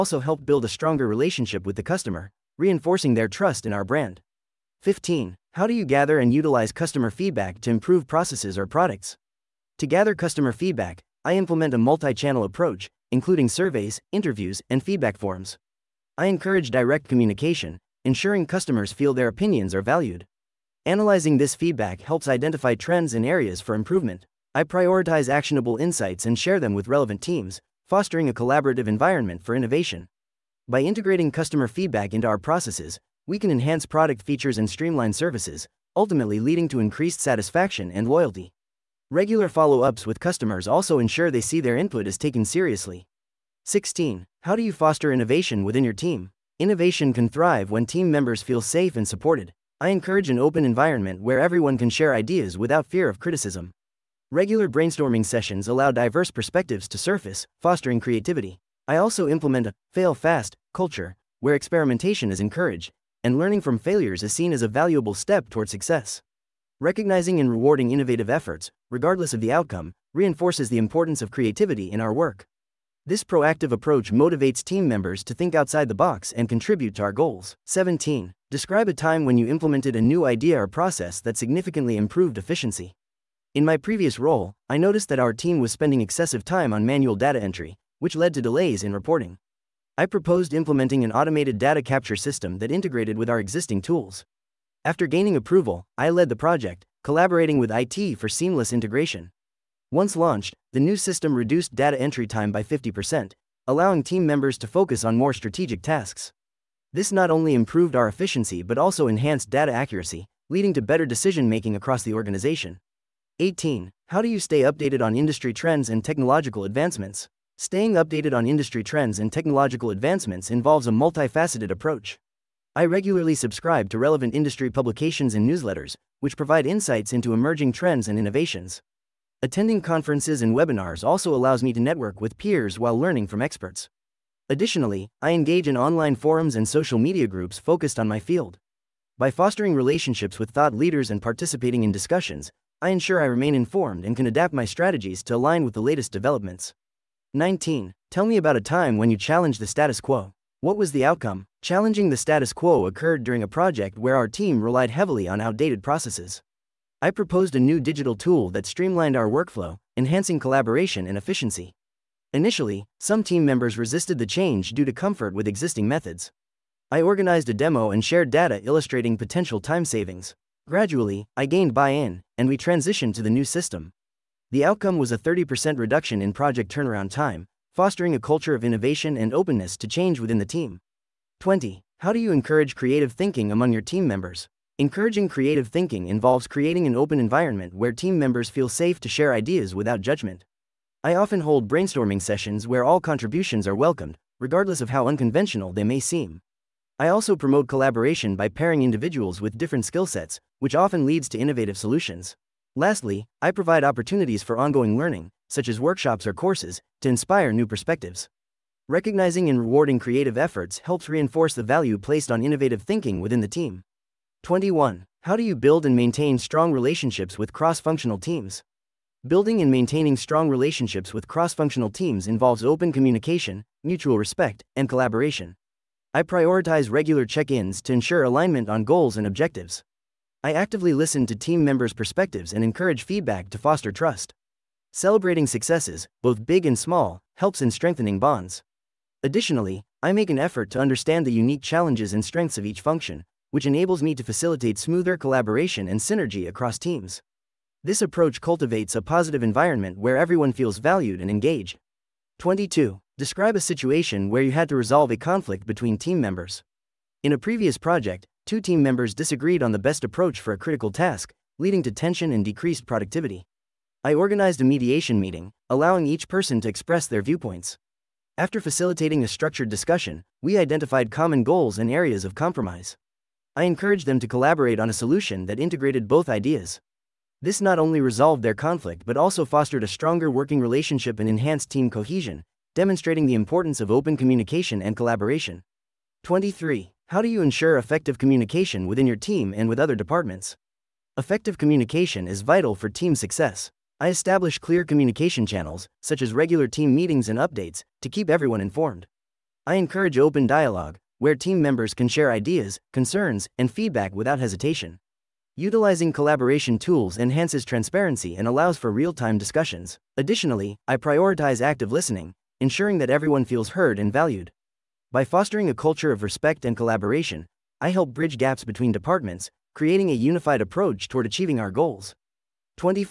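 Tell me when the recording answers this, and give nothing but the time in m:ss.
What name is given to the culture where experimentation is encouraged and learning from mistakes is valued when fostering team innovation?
0:59.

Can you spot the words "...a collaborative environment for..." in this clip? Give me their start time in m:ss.
0:28.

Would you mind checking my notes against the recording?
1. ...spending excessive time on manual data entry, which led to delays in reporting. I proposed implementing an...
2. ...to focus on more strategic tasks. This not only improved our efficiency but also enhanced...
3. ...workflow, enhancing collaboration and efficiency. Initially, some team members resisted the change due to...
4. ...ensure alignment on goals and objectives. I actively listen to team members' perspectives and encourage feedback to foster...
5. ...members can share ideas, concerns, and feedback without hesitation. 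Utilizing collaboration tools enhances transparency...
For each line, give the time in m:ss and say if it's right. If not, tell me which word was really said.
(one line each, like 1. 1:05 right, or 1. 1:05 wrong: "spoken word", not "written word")
1. 1:25 right
2. 1:44 right
3. 2:39 right
4. 3:47 right
5. 5:01 right.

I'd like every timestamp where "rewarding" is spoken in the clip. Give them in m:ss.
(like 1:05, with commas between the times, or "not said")
1:07, 3:29.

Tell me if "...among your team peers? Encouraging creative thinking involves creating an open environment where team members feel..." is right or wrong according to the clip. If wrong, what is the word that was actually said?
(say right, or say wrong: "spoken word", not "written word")
wrong: "members", not "peers".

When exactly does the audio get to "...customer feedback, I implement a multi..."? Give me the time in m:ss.
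0:10.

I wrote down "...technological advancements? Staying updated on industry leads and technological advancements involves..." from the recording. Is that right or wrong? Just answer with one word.
wrong.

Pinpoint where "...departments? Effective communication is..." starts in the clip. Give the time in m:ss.
4:49.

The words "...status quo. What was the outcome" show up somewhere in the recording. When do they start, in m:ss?
2:29.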